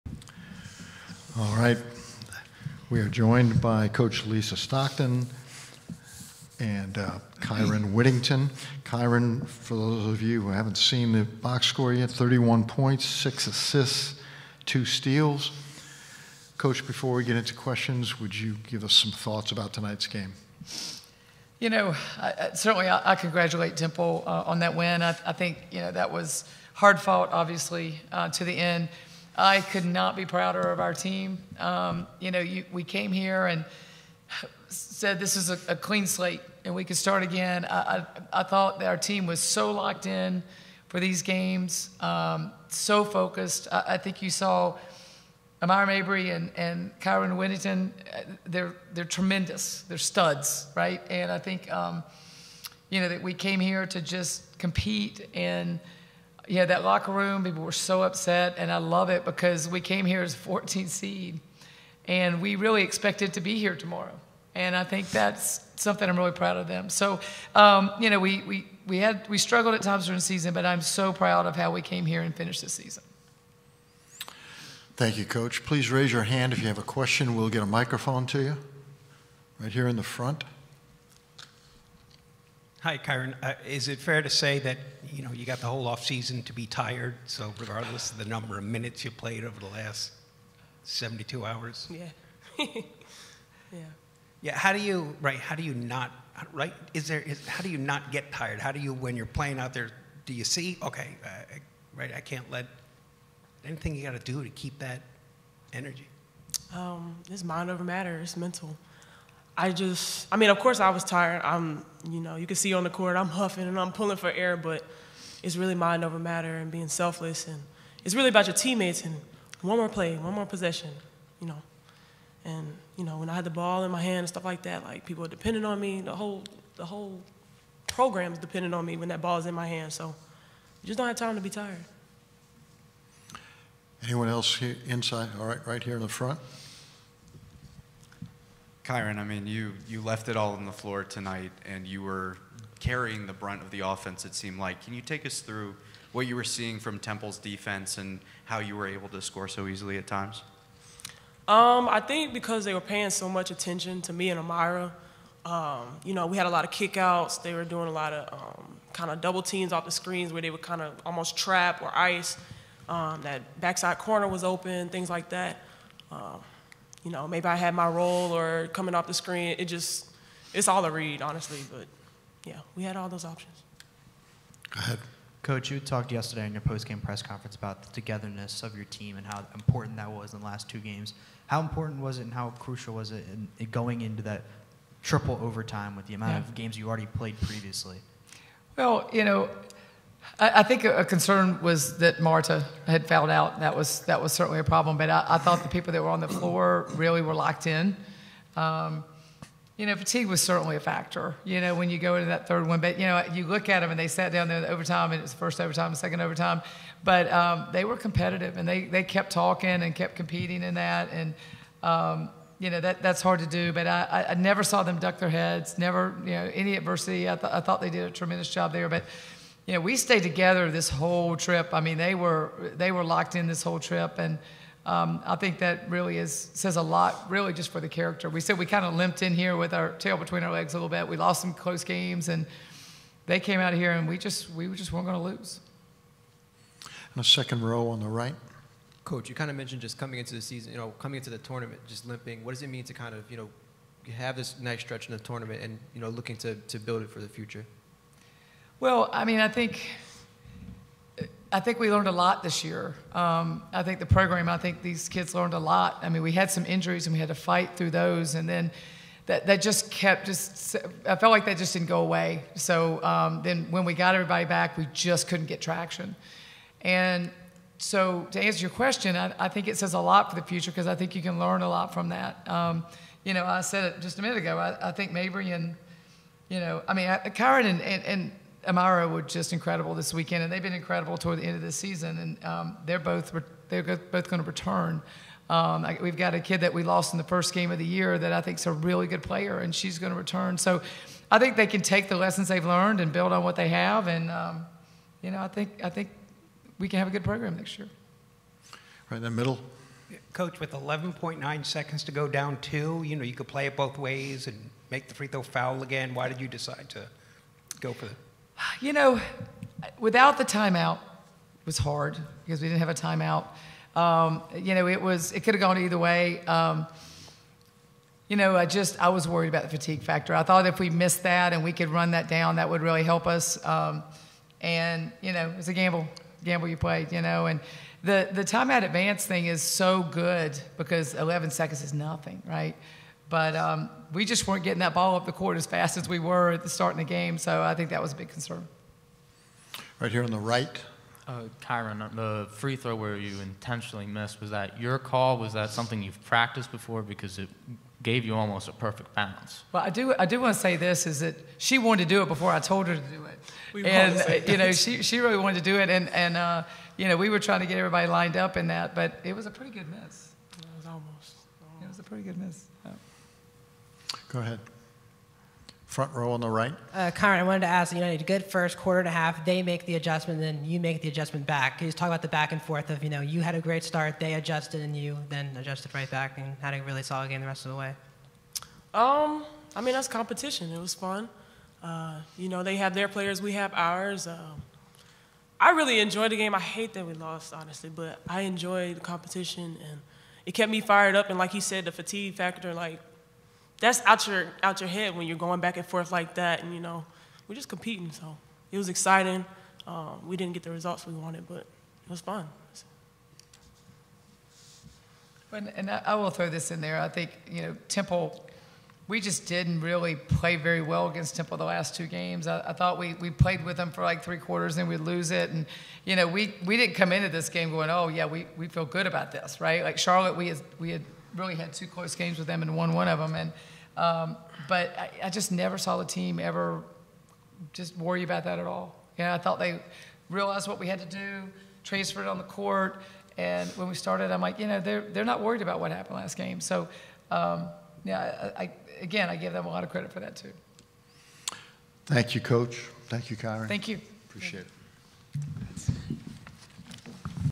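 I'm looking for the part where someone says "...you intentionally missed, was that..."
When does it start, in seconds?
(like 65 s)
343 s.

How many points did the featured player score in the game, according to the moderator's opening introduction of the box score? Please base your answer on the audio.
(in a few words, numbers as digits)
31.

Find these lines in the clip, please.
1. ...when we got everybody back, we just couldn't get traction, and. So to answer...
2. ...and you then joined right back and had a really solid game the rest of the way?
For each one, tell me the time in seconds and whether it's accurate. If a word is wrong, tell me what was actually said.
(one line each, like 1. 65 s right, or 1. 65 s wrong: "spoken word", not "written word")
1. 263 s right
2. 374 s wrong: "adjusted", not "joined".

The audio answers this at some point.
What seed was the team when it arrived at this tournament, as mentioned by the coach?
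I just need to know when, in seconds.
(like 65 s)
60 s.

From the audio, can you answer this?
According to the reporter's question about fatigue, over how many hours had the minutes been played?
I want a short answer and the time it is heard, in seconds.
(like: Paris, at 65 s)
72, at 90 s.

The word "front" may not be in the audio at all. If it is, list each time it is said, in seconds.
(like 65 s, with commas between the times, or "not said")
80 s, 136 s, 365 s.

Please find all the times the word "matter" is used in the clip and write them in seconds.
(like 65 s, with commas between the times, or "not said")
107 s, 116 s.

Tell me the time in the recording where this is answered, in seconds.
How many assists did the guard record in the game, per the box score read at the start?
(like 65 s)
13 s.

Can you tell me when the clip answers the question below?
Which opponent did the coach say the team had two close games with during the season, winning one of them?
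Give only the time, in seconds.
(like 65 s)
419 s.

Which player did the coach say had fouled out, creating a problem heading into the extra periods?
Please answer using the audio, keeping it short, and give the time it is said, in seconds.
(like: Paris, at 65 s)
Marta, at 192 s.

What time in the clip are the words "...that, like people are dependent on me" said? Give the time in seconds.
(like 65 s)
124 s.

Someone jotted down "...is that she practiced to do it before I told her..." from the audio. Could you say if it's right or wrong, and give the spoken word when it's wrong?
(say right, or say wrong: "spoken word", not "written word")
wrong: "wanted", not "practiced".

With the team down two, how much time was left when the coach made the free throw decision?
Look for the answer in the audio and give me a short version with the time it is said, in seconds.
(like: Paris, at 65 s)
11.9, at 300 s.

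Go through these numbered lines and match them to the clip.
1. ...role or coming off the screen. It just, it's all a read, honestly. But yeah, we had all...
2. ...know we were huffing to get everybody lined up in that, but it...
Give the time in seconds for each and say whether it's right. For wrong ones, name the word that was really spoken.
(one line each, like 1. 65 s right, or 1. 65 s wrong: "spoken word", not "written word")
1. 167 s right
2. 357 s wrong: "trying", not "huffing".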